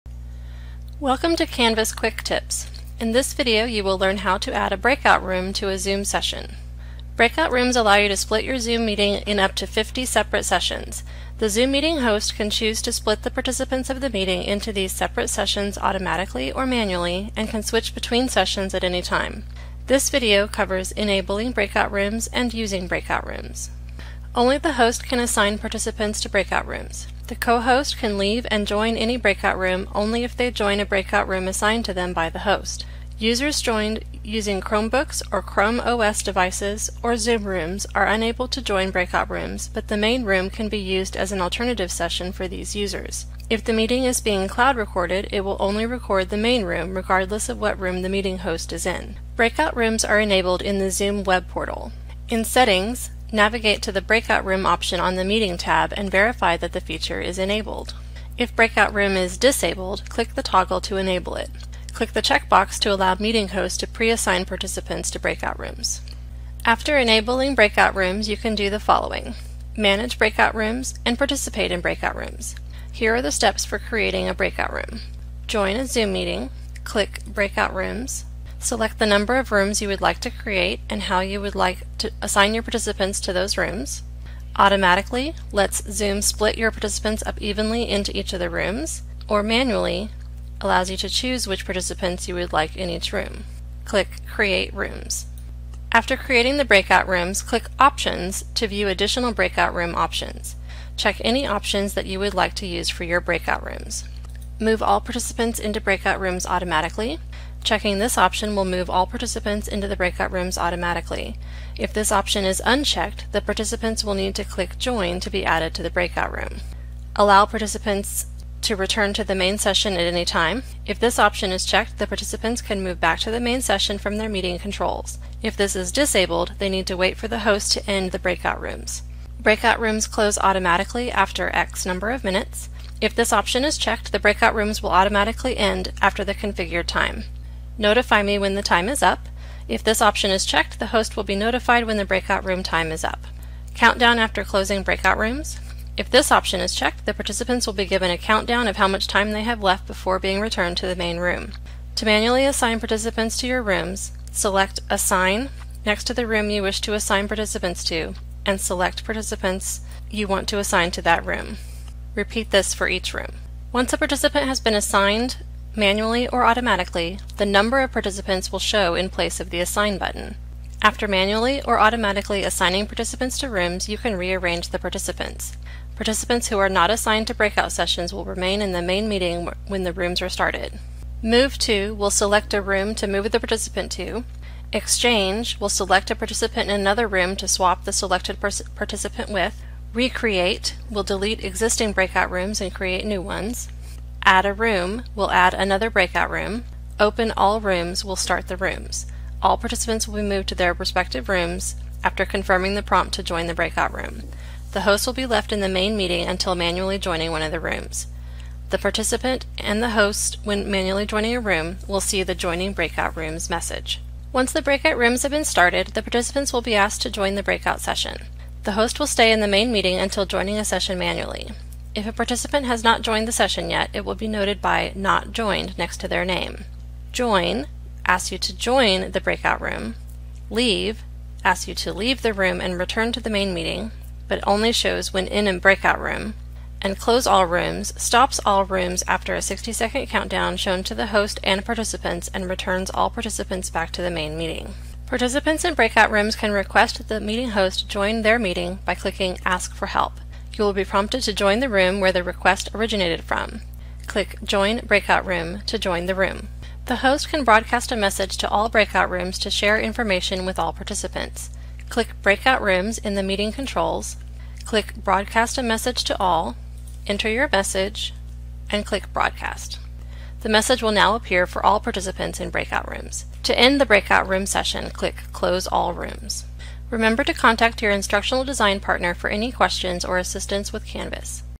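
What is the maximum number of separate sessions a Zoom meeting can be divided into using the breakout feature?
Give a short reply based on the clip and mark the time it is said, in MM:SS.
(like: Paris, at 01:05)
50, at 00:09.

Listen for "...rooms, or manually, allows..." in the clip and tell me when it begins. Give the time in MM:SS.
01:28.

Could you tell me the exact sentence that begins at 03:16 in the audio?
Open all rooms will start the rooms.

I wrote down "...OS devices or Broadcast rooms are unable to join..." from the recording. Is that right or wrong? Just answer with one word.
wrong.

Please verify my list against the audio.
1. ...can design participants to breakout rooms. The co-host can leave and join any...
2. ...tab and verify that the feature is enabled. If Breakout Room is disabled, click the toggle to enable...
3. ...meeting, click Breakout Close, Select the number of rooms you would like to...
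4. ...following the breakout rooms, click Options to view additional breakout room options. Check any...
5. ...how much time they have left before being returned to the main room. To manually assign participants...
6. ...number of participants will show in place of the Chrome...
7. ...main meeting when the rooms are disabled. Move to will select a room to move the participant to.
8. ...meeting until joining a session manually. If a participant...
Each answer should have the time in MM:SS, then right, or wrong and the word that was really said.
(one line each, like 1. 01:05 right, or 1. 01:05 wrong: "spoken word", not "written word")
1. 00:25 wrong: "assign", not "design"
2. 00:55 right
3. 01:16 wrong: "Rooms", not "Close"
4. 01:36 wrong: "creating", not "following"
5. 02:28 right
6. 02:47 wrong: "Assign", not "Chrome"
7. 02:58 wrong: "started", not "disabled"
8. 03:39 right.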